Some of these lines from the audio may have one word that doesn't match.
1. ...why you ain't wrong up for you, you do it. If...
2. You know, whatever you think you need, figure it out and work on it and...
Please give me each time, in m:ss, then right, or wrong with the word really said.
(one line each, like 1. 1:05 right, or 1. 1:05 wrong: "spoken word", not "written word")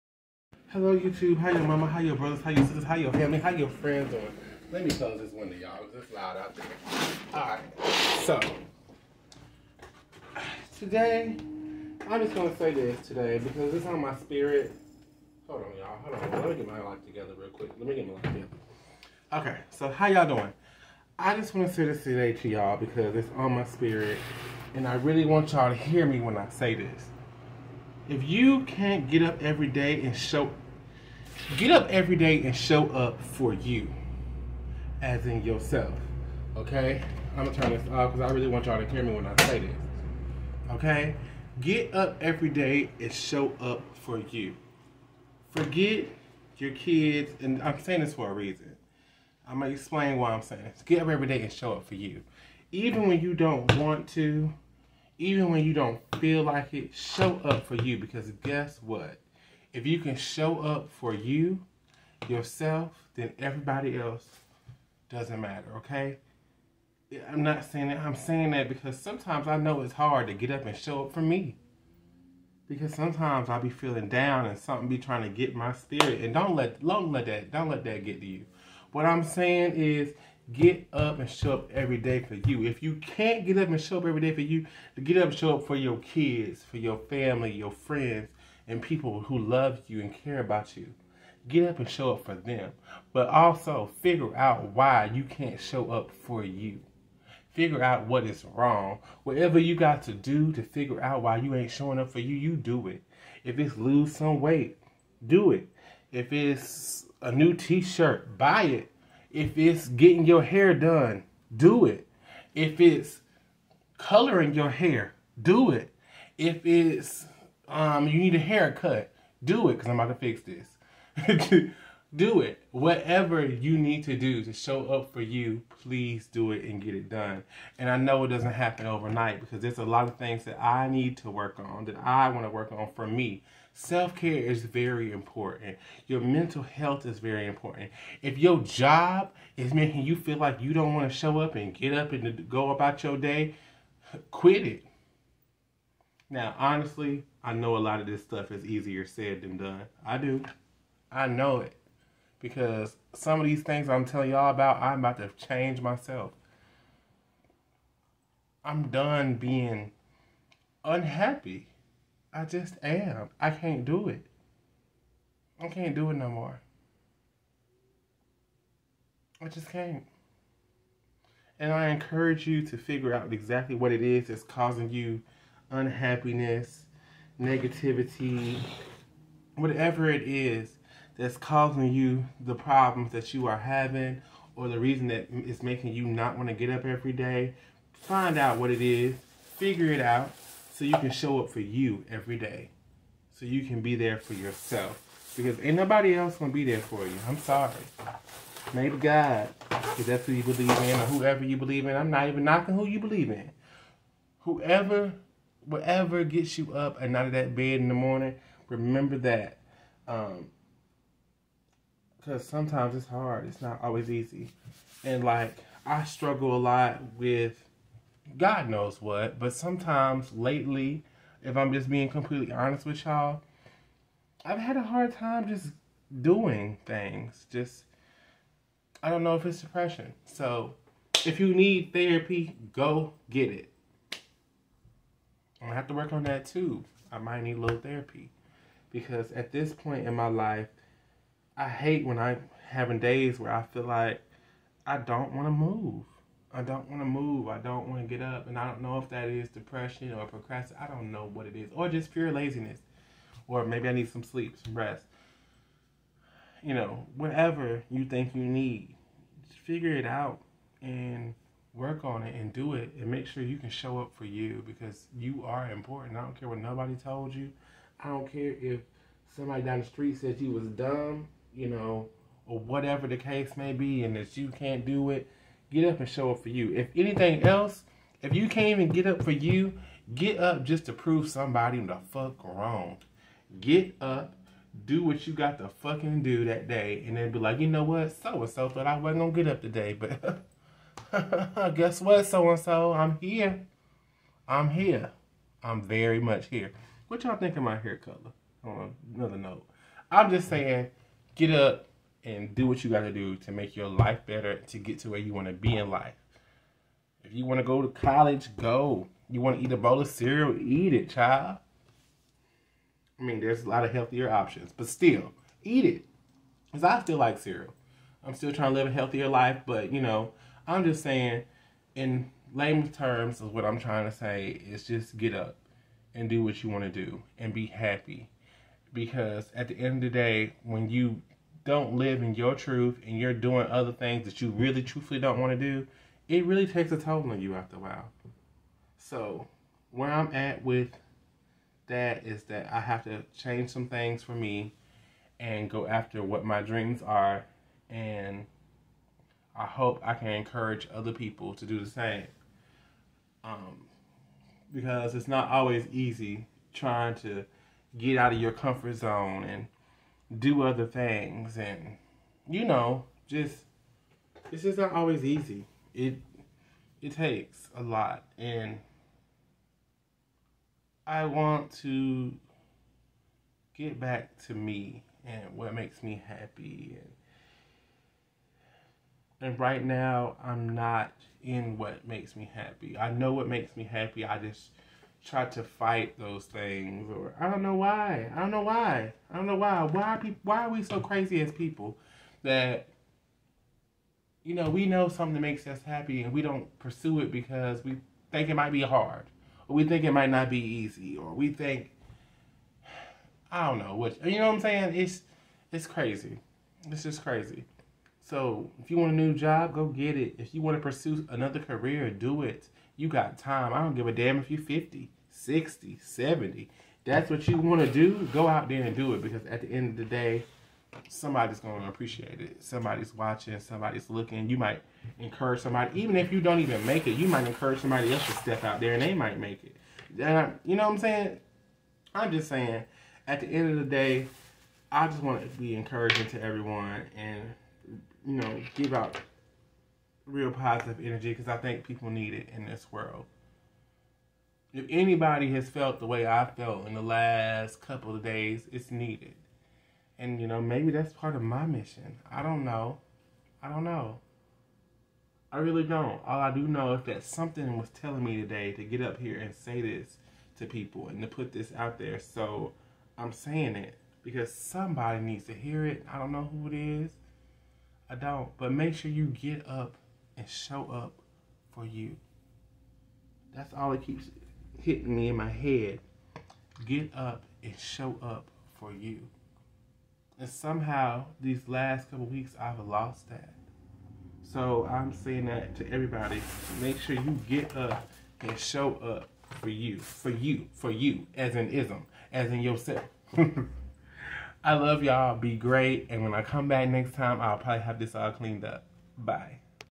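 1. 1:41 wrong: "showing", not "wrong"
2. 4:16 right.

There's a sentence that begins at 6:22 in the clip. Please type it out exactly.
I know what makes me happy.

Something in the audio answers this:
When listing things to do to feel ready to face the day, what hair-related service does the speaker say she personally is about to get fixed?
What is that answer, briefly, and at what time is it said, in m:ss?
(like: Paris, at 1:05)
Haircut, at 1:58.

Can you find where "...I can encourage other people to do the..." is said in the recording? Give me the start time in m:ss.
5:50.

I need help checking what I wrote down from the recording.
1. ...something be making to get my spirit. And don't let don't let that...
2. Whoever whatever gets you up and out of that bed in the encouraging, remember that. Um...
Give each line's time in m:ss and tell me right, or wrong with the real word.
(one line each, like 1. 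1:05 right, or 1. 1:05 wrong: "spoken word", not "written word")
1. 1:14 wrong: "trying", not "making"
2. 3:24 wrong: "morning", not "encouraging".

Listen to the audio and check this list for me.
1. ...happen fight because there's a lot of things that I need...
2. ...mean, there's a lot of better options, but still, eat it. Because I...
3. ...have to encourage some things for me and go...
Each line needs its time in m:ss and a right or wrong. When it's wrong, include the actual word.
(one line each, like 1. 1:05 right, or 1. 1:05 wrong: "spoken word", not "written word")
1. 2:08 wrong: "overnight", not "fight"
2. 5:13 wrong: "healthier", not "better"
3. 5:42 wrong: "change", not "encourage".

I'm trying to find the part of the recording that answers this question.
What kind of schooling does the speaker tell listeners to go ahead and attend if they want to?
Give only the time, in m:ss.
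5:07.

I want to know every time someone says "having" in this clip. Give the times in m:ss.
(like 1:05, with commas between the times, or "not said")
3:03, 4:02.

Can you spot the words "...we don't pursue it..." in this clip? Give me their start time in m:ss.
6:36.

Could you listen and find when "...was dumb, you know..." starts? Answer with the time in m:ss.
4:30.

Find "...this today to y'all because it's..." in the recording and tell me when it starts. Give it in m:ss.
0:21.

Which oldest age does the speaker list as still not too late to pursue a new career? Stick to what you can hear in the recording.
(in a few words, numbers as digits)
70.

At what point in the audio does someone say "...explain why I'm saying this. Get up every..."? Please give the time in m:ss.
0:49.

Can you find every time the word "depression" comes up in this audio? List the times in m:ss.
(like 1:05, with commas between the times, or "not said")
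3:49, 4:09.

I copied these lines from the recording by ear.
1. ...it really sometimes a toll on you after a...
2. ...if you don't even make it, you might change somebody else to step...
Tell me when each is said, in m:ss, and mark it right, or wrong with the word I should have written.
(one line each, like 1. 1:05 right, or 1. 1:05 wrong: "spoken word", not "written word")
1. 5:36 wrong: "takes", not "sometimes"
2. 7:06 wrong: "encourage", not "change".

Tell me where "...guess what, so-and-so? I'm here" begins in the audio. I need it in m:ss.
4:51.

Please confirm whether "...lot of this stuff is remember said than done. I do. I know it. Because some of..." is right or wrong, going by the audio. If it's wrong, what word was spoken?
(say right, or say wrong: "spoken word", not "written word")
wrong: "easier", not "remember".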